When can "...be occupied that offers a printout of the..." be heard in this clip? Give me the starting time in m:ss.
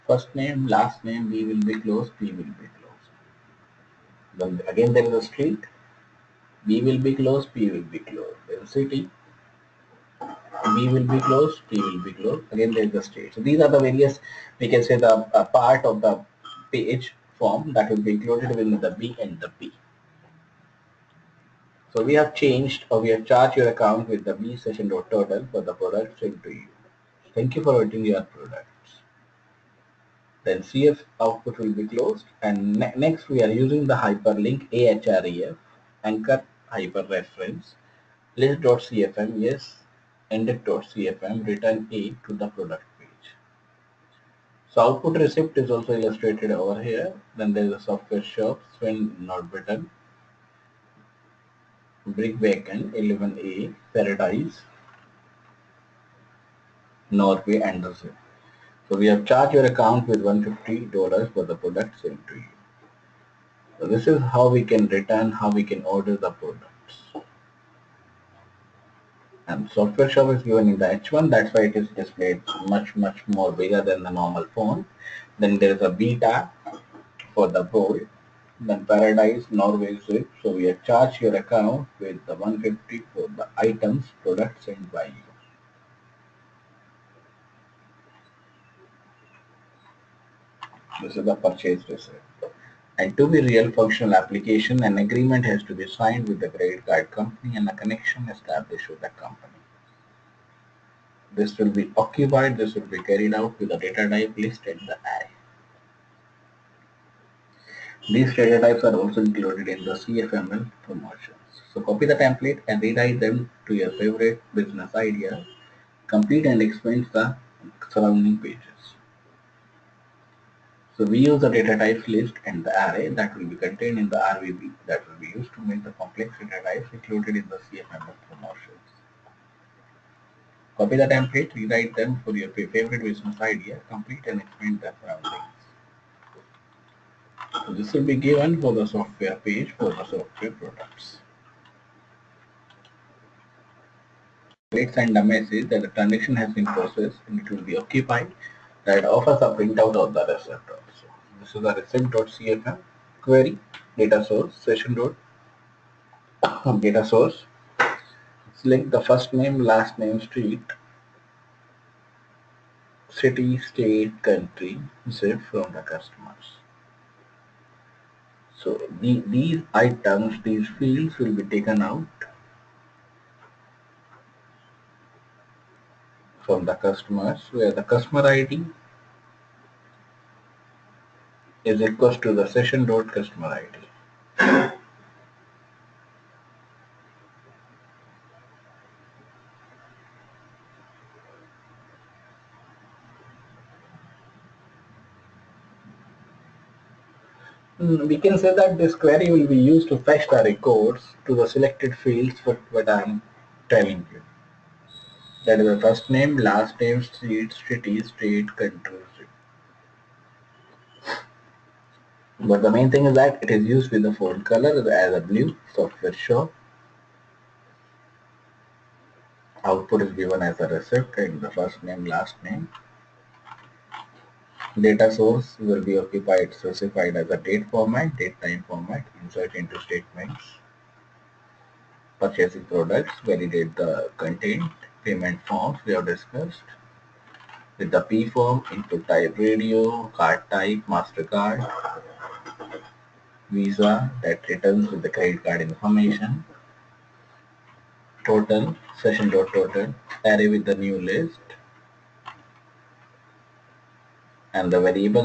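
2:27.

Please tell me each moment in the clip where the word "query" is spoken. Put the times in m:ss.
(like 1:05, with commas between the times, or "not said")
2:33, 3:18.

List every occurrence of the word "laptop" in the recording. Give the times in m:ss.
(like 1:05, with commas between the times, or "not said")
not said.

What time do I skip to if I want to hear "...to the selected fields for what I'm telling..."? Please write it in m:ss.
3:21.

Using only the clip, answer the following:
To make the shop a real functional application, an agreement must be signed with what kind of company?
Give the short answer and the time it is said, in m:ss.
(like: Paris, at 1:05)
credit card company, at 1:36.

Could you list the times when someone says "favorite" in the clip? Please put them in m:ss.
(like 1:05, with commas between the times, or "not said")
1:53, 2:12.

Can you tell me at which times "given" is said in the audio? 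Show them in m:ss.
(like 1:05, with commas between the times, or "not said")
1:10, 2:18, 3:40.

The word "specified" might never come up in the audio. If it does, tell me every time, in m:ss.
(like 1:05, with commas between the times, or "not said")
3:46.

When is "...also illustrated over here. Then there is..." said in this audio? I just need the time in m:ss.
0:45.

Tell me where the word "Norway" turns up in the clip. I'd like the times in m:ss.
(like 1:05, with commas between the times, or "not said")
0:57, 1:19.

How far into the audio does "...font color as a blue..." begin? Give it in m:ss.
3:34.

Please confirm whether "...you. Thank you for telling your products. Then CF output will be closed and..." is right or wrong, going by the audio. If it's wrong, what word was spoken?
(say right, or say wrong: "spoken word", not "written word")
wrong: "ordering", not "telling".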